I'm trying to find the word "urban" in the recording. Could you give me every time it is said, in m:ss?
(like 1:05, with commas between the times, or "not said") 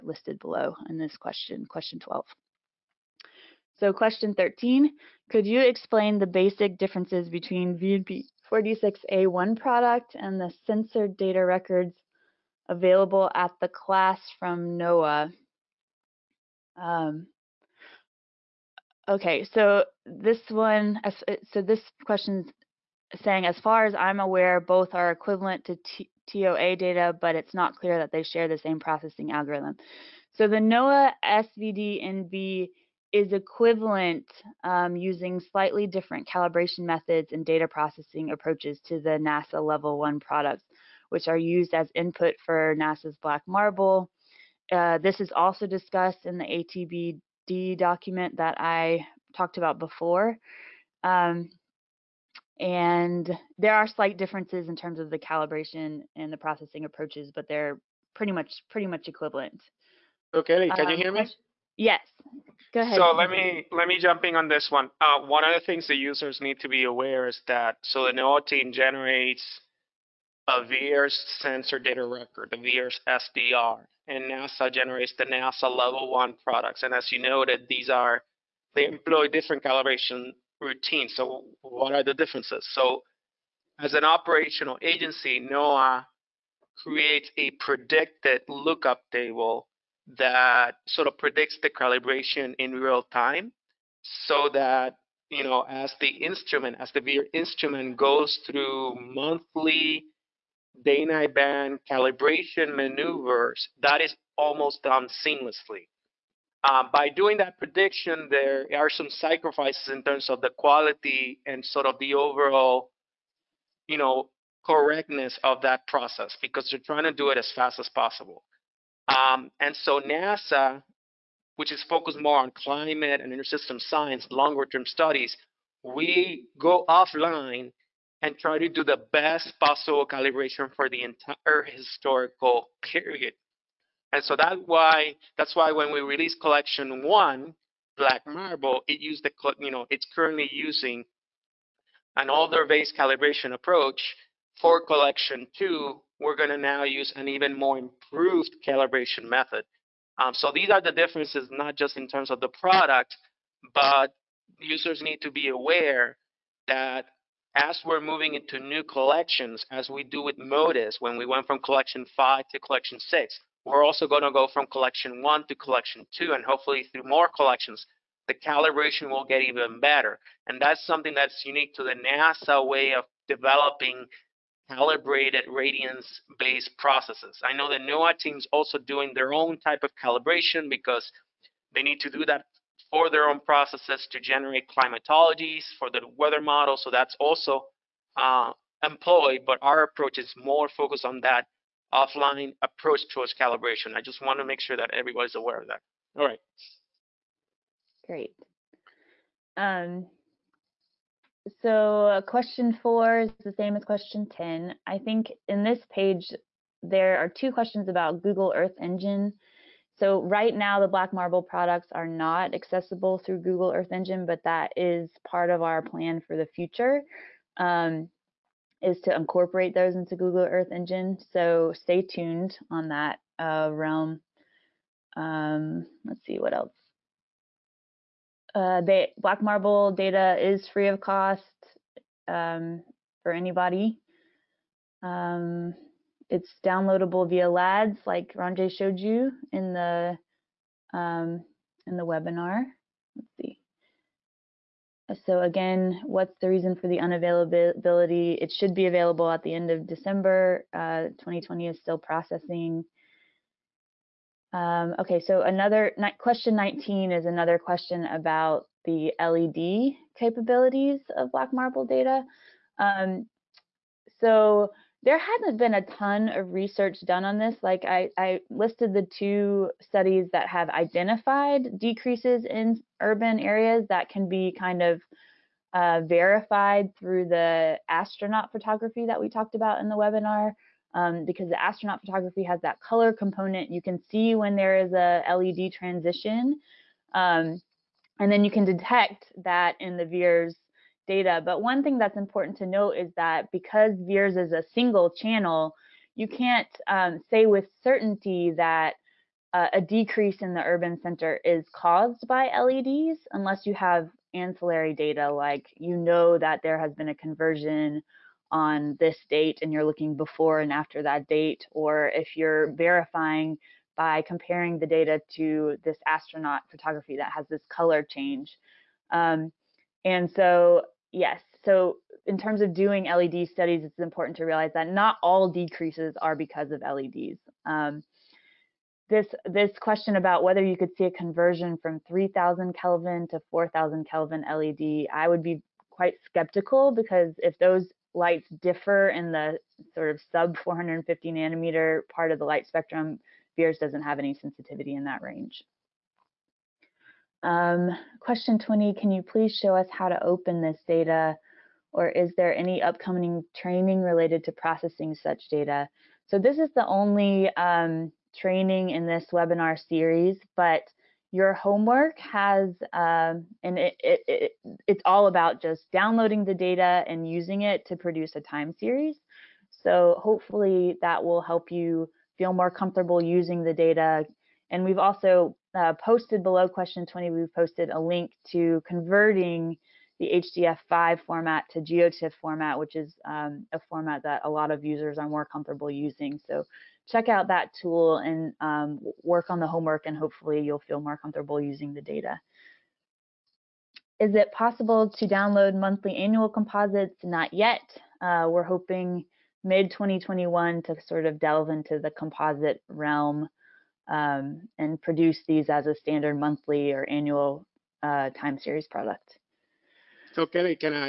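4:33, 5:00.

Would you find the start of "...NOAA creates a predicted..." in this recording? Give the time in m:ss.
1:25.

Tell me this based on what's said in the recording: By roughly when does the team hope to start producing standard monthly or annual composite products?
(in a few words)
mid 2021.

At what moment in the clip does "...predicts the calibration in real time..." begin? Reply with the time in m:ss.
1:31.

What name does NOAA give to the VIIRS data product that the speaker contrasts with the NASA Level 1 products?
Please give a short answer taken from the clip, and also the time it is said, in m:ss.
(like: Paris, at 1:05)
VIIRS sensor data record, at 1:10.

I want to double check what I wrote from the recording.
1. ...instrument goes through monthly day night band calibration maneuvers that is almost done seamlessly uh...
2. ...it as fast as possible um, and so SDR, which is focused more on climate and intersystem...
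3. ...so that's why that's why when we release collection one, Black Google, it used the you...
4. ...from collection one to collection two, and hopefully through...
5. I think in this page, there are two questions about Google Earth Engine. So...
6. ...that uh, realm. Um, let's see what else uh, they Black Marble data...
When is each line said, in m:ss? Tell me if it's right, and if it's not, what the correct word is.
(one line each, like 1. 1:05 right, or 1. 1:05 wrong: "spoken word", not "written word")
1. 1:37 right
2. 1:57 wrong: "NASA", not "SDR"
3. 2:14 wrong: "Marble", not "Google"
4. 2:44 right
5. 3:24 right
6. 3:42 right.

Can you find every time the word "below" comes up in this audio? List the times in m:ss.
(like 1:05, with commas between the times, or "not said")
0:00, 6:16.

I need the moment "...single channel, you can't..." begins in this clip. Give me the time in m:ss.
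4:54.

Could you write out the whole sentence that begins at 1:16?
And as you noted, these are they employ different calibration routines.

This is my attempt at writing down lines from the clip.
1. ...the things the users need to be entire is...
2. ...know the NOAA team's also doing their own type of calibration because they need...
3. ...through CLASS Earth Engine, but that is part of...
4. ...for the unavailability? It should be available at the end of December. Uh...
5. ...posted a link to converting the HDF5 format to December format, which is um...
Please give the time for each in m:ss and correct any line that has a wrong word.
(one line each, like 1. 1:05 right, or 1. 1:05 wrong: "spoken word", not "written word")
1. 1:05 wrong: "aware", not "entire"
2. 2:57 right
3. 3:33 wrong: "Google", not "CLASS"
4. 4:06 right
5. 6:17 wrong: "GeoTIFF", not "December".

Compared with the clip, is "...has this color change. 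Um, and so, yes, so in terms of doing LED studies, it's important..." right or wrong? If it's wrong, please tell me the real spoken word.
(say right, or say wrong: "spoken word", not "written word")
right.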